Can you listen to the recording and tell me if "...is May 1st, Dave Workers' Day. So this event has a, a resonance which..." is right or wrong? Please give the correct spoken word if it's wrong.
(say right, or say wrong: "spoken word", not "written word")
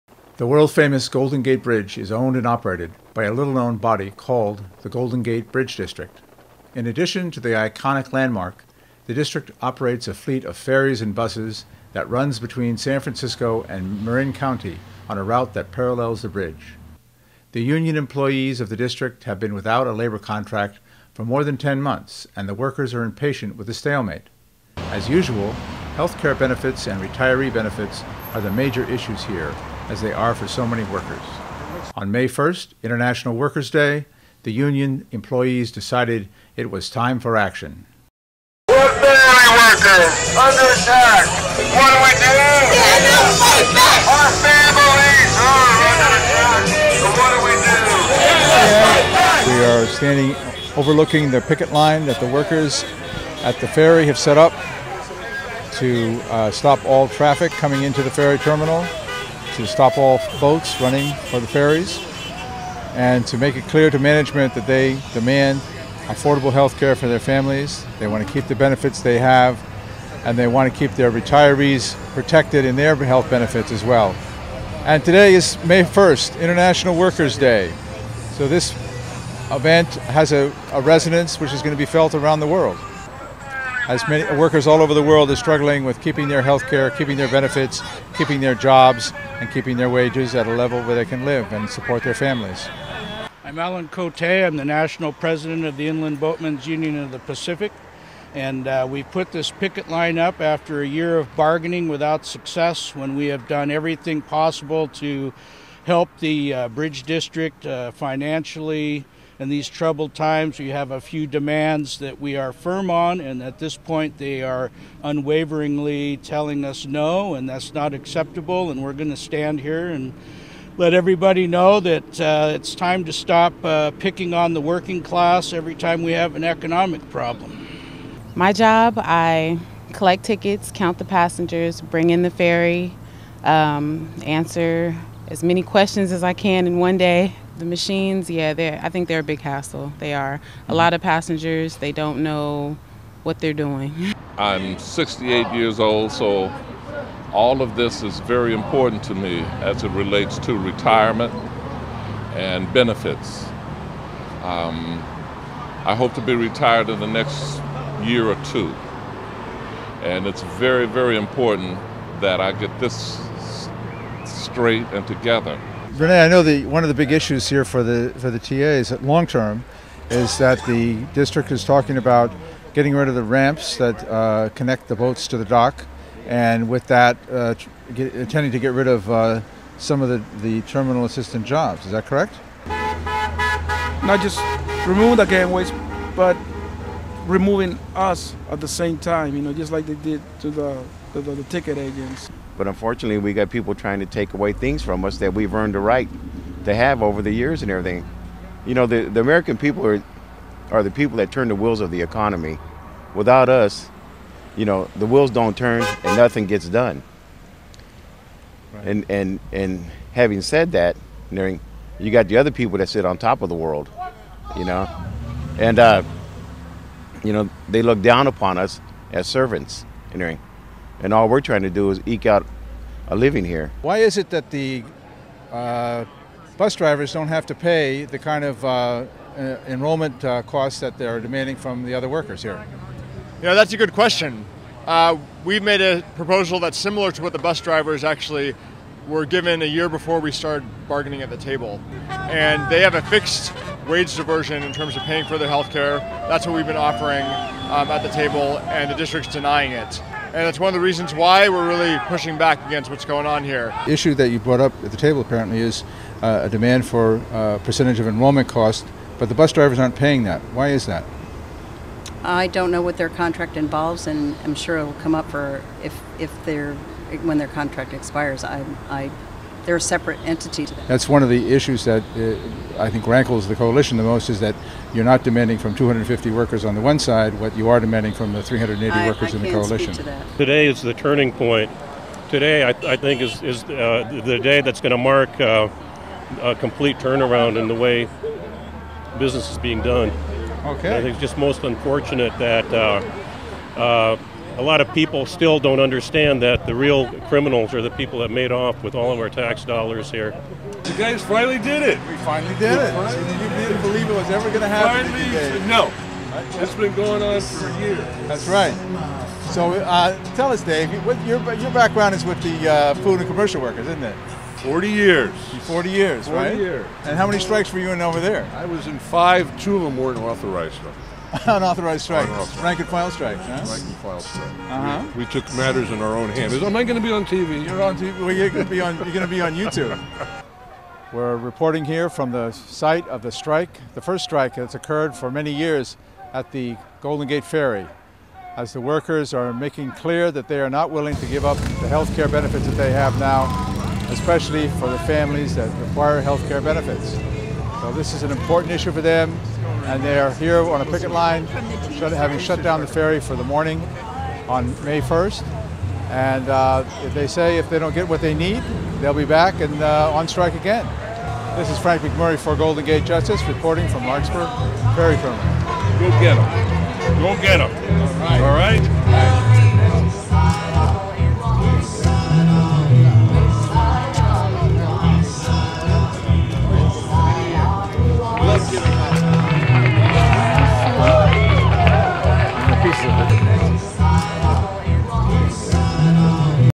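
wrong: "International", not "Dave".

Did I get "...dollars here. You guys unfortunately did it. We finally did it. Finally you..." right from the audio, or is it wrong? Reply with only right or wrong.
wrong.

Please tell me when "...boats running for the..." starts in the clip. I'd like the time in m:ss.
1:00.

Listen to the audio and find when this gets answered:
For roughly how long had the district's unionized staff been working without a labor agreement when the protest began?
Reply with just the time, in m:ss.
0:21.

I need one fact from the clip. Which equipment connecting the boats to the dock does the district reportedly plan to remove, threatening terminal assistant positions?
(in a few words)
the ramps.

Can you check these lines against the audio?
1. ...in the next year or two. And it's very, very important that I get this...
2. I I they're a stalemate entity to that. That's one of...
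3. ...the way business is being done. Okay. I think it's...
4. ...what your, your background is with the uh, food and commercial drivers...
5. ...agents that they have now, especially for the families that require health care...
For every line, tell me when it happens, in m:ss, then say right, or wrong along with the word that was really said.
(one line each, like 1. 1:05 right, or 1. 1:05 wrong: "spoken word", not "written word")
1. 2:36 right
2. 4:28 wrong: "separate", not "stalemate"
3. 4:47 right
4. 5:11 wrong: "workers", not "drivers"
5. 5:42 wrong: "benefits", not "agents".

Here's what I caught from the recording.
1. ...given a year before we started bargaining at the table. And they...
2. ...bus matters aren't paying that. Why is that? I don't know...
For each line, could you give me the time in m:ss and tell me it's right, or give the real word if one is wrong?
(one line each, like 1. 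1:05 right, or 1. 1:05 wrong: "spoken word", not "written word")
1. 3:59 right
2. 4:19 wrong: "drivers", not "matters".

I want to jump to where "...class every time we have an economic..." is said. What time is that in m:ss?
2:05.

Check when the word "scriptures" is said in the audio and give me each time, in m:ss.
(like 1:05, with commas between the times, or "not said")
not said.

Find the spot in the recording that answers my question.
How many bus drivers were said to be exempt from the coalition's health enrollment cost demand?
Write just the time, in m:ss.
4:35.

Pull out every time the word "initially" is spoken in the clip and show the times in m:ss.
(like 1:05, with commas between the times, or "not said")
not said.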